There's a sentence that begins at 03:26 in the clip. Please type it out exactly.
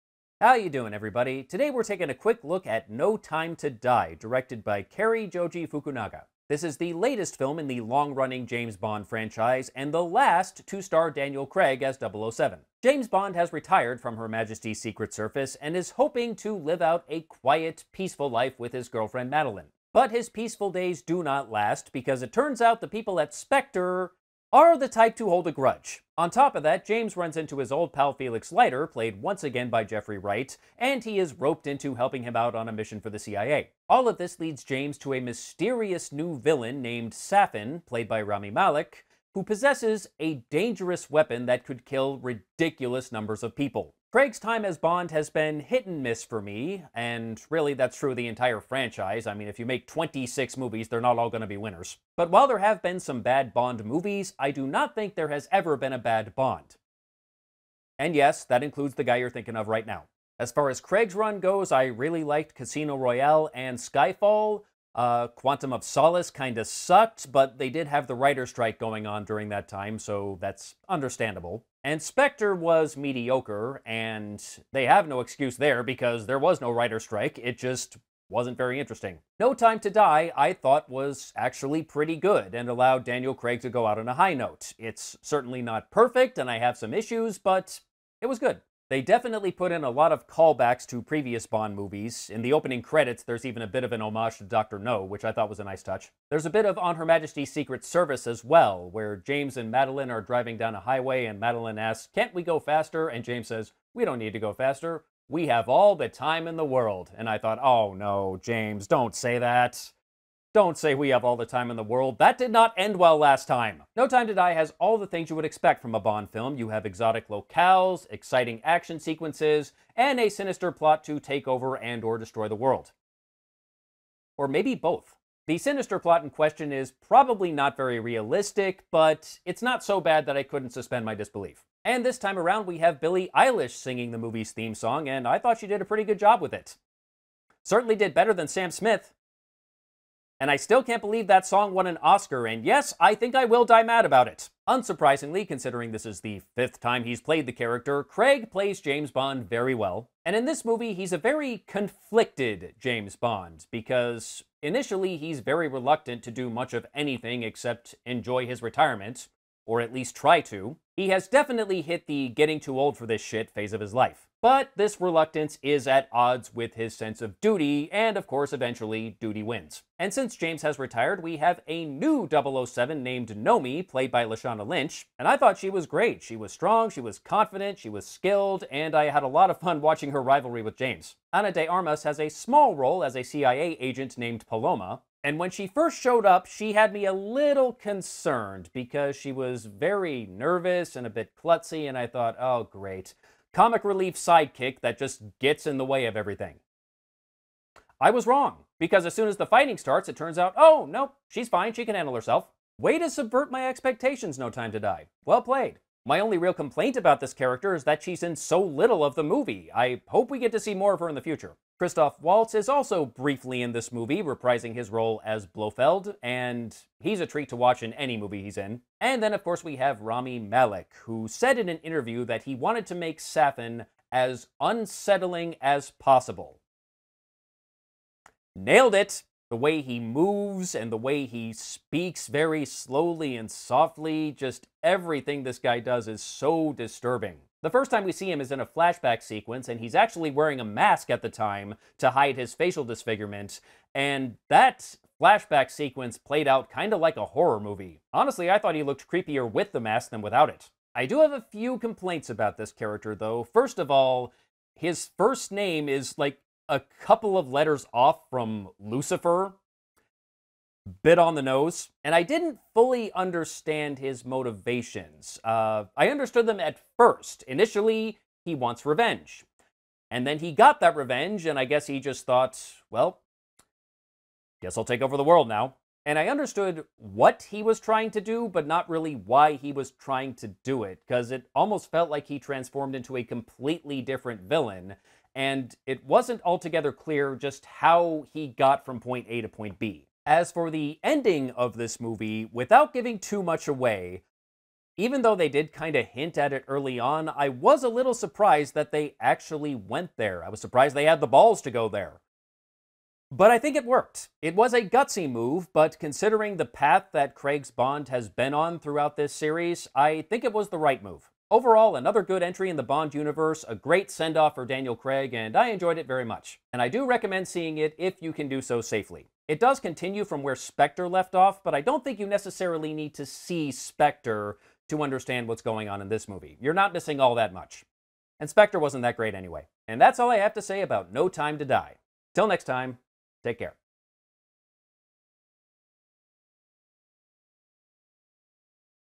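My only real complaint about this character is that she's in so little of the movie.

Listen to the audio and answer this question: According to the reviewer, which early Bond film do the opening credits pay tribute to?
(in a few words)
Dr. No.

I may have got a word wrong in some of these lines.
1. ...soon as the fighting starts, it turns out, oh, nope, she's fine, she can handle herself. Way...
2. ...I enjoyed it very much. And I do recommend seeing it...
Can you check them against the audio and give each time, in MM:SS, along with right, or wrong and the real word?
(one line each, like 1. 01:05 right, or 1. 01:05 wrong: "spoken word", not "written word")
1. 03:19 right
2. 05:15 right.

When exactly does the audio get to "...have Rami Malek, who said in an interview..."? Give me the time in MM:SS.
03:39.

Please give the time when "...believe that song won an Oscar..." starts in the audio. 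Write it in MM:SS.
02:21.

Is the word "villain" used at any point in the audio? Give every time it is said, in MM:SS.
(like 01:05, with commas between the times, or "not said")
00:36, 04:44.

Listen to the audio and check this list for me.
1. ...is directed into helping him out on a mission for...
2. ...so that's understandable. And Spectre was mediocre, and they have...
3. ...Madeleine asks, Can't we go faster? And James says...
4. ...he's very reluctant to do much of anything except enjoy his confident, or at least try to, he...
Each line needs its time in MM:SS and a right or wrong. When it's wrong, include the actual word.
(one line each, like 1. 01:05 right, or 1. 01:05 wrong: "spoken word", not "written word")
1. 00:31 wrong: "roped", not "directed"
2. 01:09 right
3. 01:41 right
4. 02:35 wrong: "retirement", not "confident".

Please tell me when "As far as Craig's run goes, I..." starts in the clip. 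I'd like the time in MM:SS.
01:00.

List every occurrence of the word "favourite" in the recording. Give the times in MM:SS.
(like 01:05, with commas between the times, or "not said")
not said.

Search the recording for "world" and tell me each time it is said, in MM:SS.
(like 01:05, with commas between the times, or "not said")
01:46, 01:51, 02:02, 04:35.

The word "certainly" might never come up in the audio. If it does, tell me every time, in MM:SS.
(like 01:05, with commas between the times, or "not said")
01:25, 02:17.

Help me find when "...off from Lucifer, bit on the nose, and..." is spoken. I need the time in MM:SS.
04:17.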